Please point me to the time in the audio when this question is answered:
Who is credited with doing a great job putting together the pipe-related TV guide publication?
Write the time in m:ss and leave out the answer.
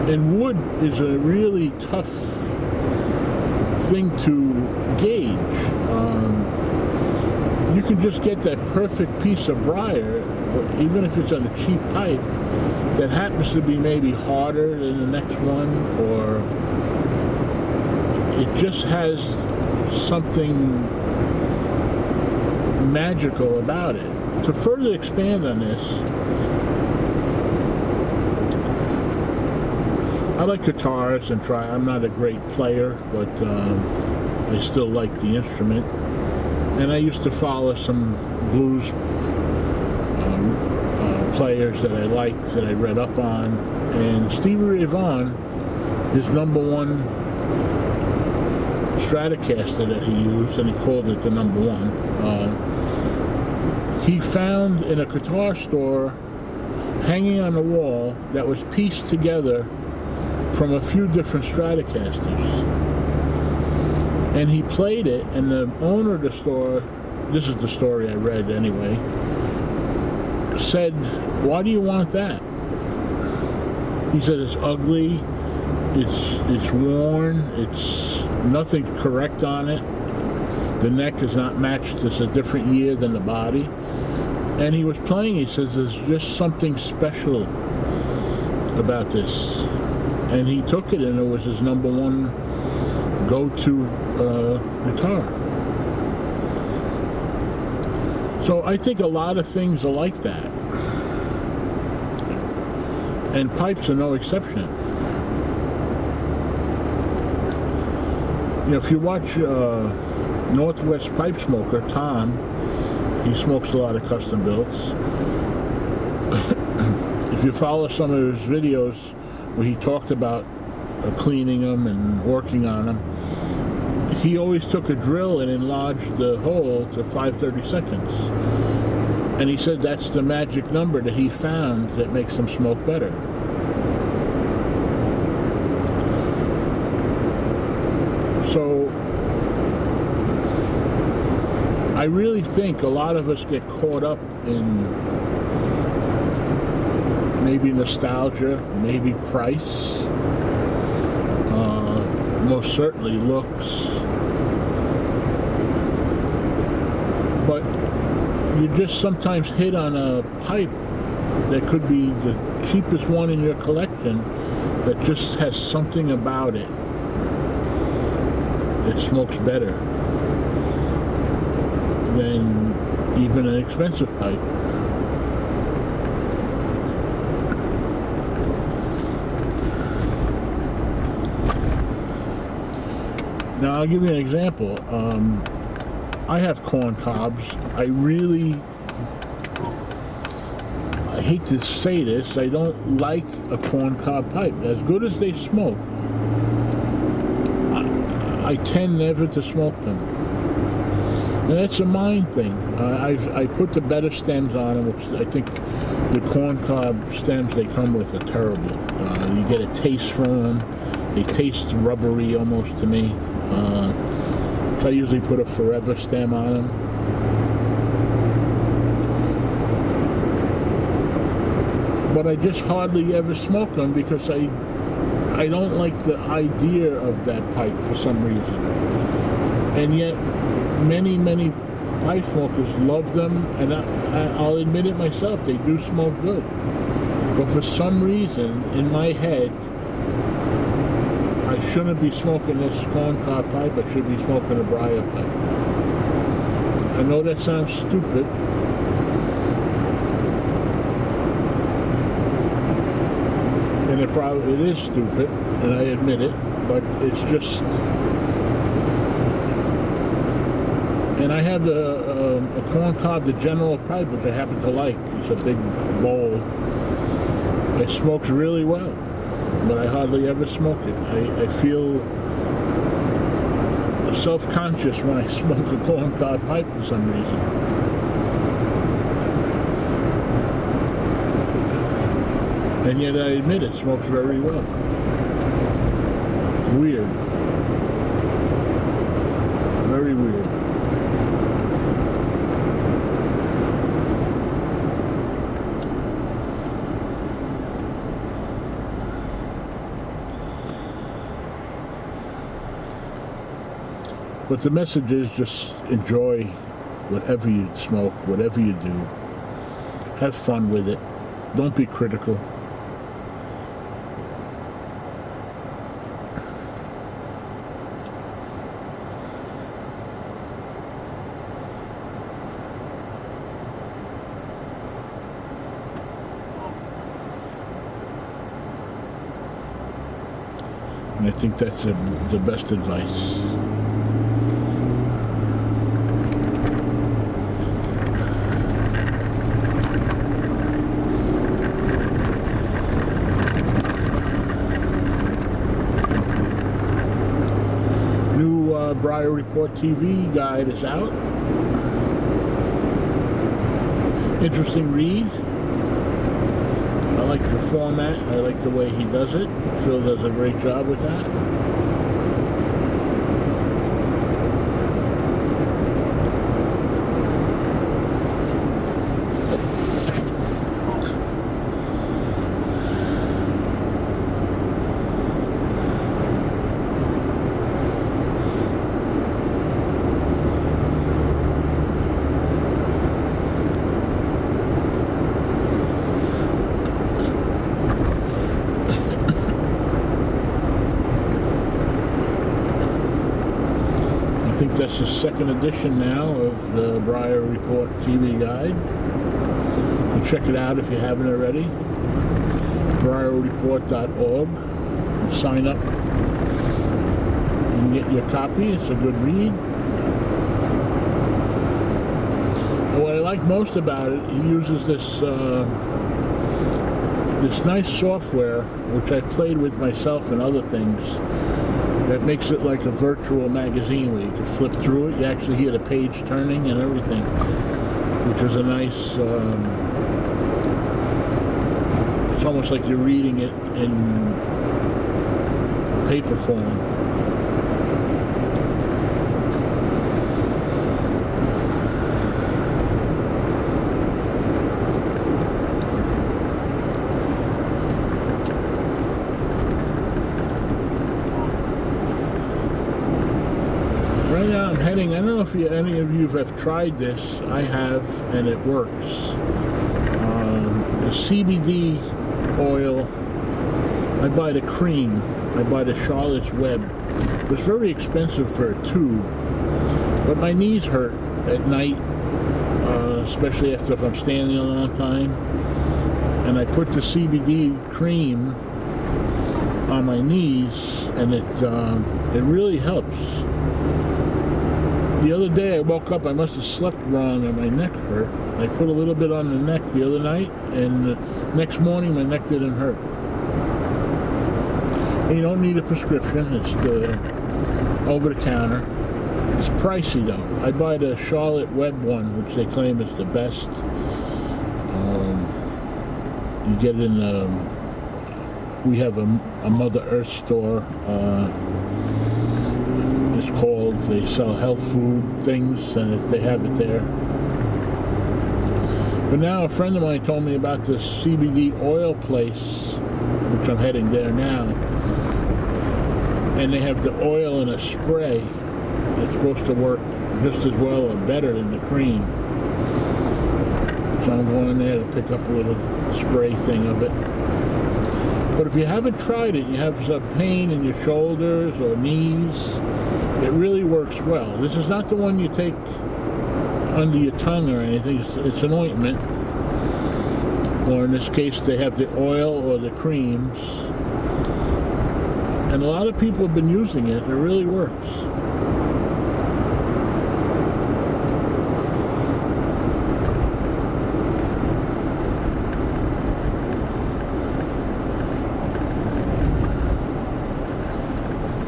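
5:59.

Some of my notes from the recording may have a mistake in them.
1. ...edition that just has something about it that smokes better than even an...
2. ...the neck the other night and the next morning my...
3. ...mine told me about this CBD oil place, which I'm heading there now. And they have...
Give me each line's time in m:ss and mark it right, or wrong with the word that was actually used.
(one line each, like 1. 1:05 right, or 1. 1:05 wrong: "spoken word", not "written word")
1. 2:43 wrong: "collection", not "edition"
2. 8:09 right
3. 8:40 right.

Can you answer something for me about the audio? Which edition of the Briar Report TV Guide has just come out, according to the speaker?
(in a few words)
Second.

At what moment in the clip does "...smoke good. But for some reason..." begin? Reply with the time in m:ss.
3:55.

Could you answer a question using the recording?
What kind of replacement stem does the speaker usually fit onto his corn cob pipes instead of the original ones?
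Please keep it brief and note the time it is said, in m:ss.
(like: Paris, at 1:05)
forever stem, at 3:35.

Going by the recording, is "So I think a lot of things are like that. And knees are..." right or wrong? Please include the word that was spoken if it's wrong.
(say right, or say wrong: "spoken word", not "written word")
wrong: "pipes", not "knees".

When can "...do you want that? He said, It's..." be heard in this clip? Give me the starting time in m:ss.
1:11.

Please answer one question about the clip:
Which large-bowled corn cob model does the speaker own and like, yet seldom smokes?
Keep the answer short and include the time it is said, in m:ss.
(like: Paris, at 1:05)
The General, at 4:23.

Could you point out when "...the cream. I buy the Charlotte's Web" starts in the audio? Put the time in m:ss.
7:44.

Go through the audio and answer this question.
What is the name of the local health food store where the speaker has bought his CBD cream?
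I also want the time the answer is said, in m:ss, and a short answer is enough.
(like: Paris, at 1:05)
Mother Earth, at 8:29.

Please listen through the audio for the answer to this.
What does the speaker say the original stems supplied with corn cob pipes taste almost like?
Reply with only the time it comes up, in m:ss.
3:31.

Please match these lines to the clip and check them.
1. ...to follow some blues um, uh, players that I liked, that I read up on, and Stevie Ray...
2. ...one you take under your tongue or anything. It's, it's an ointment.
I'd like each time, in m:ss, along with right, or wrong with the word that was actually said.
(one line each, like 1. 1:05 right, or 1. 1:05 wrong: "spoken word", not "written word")
1. 0:37 right
2. 9:05 right.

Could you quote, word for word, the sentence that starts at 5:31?
And I think that's the, the best advice.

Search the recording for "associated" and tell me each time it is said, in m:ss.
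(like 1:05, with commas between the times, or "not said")
not said.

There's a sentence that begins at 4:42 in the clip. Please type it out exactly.
And yet I admit it smokes very well.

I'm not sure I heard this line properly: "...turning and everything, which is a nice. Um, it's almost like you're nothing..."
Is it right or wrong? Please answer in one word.
wrong.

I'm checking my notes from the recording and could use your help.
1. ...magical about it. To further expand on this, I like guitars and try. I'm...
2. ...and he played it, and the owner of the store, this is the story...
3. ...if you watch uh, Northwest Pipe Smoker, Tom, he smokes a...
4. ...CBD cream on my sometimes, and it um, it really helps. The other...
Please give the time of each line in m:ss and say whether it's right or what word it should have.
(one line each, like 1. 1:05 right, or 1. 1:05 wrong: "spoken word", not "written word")
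1. 0:22 right
2. 1:04 right
3. 1:48 right
4. 7:57 wrong: "knees", not "sometimes".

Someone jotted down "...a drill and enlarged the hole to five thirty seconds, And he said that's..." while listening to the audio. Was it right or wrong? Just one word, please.
right.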